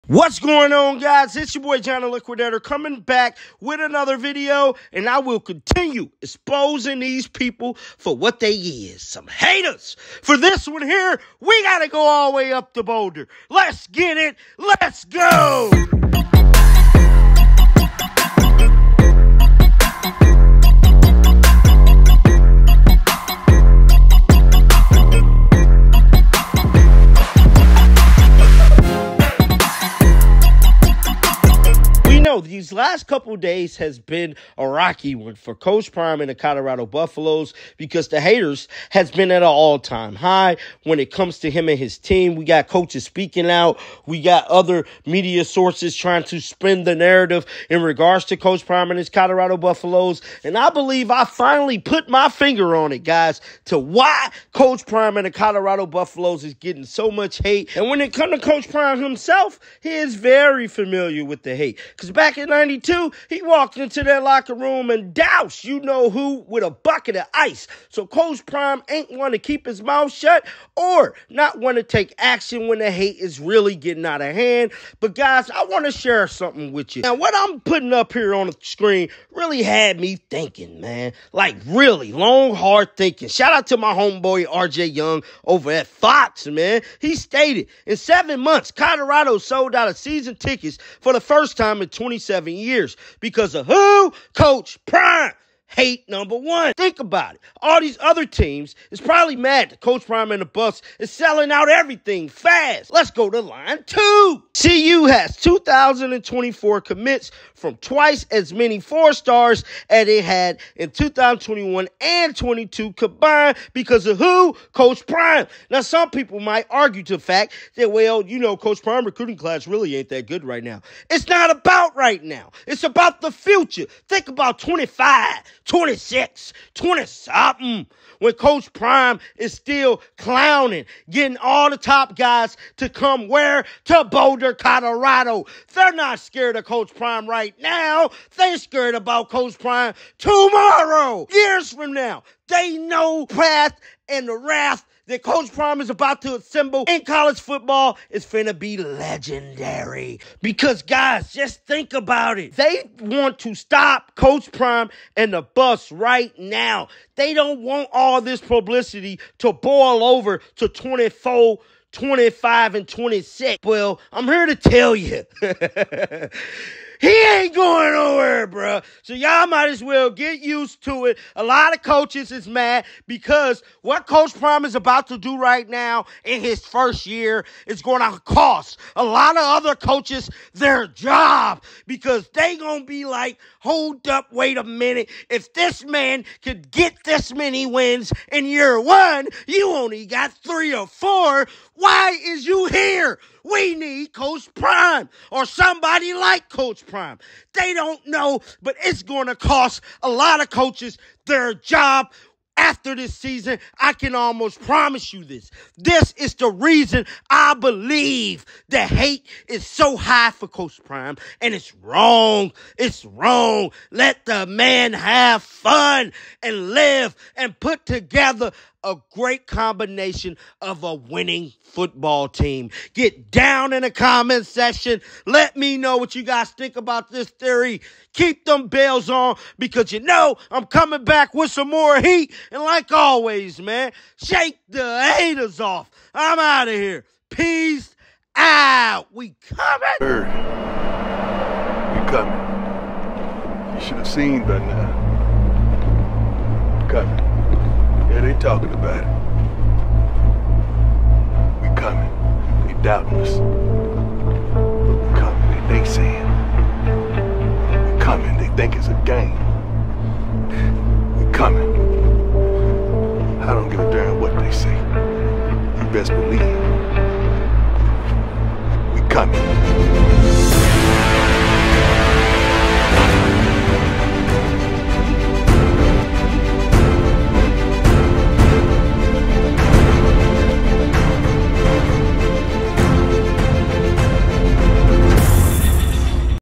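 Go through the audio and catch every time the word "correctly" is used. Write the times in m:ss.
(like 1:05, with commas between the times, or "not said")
not said.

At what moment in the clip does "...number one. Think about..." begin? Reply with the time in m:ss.
1:36.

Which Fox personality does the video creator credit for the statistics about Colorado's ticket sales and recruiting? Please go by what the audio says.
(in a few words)
RJ Young.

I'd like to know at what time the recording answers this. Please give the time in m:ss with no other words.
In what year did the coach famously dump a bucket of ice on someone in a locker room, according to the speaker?
1:02.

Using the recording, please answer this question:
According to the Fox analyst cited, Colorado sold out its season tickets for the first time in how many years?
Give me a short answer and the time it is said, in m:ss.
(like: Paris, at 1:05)
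27, at 1:31.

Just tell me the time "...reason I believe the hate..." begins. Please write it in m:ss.
3:26.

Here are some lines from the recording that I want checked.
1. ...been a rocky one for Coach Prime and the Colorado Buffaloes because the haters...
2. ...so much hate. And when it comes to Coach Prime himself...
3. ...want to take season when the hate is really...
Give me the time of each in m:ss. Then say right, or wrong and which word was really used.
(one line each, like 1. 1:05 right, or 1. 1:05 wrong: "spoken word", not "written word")
1. 0:33 right
2. 0:56 right
3. 1:11 wrong: "action", not "season".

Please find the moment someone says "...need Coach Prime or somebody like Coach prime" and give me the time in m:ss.
3:13.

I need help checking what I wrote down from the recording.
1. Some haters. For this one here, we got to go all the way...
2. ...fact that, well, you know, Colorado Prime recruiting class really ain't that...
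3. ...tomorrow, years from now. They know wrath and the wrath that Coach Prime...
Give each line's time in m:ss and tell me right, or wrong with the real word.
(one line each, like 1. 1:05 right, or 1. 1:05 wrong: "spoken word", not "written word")
1. 0:09 right
2. 1:57 wrong: "Coach", not "Colorado"
3. 2:20 right.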